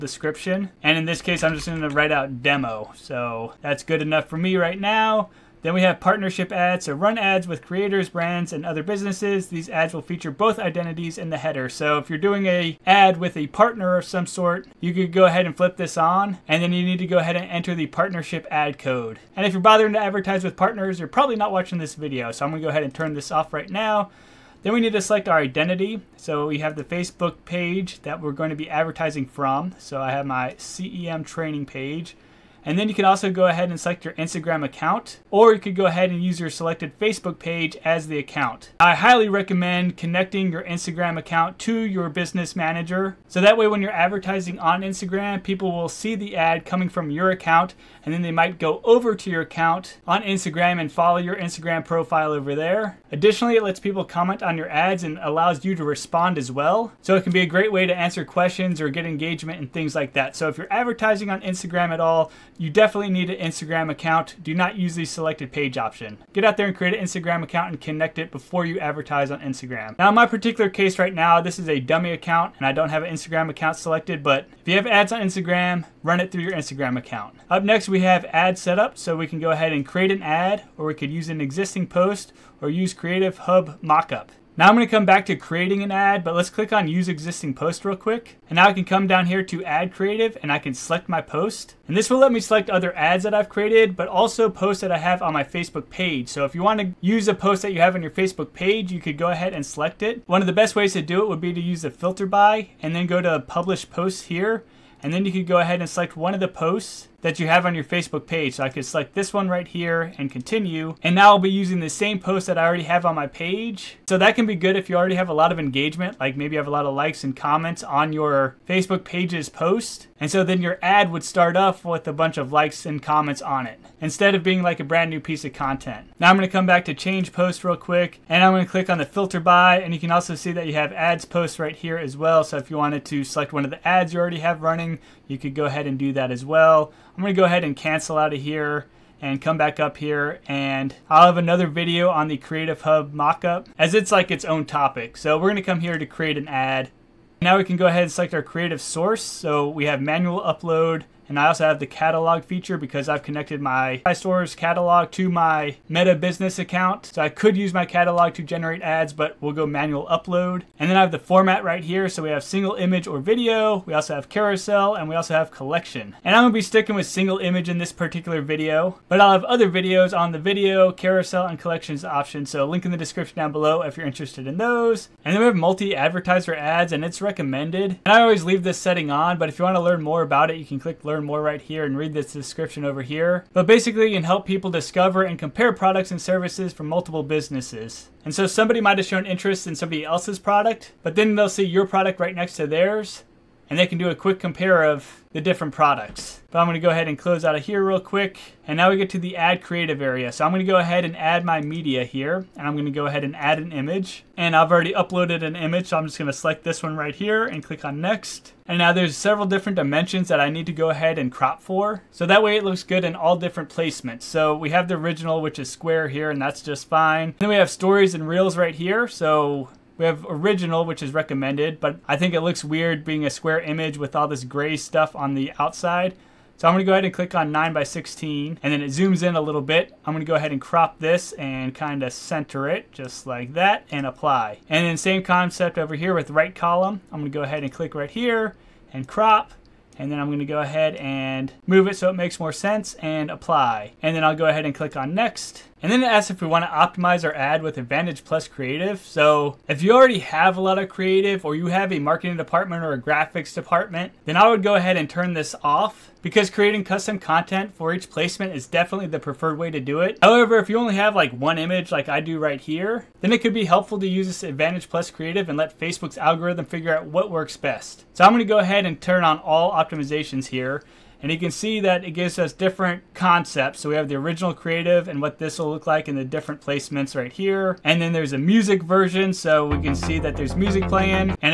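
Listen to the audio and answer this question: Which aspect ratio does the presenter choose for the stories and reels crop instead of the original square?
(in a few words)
9 by 16.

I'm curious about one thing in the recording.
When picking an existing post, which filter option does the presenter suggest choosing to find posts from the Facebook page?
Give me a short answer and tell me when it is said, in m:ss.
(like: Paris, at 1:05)
publish posts, at 1:43.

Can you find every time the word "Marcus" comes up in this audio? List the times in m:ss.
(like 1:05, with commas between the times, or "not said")
not said.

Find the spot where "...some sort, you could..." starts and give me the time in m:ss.
0:14.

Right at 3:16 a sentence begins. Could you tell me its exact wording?
But I'm gonna go ahead and close out of here real quick.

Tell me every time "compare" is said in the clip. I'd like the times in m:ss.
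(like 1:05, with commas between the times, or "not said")
3:05, 3:14.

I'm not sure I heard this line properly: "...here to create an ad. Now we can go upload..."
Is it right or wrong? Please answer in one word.
wrong.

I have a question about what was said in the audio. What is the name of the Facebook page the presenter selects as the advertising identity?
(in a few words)
CEM training.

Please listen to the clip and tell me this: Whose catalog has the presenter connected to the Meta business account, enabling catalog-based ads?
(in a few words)
iStore's.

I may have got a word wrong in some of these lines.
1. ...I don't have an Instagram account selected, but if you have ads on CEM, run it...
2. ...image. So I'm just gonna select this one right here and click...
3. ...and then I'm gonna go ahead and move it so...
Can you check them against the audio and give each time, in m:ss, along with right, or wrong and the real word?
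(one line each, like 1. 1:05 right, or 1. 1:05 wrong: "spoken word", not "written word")
1. 1:12 wrong: "Instagram", not "CEM"
2. 3:25 right
3. 3:59 right.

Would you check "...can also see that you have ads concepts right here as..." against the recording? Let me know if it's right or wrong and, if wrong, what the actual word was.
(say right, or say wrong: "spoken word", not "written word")
wrong: "posts", not "concepts".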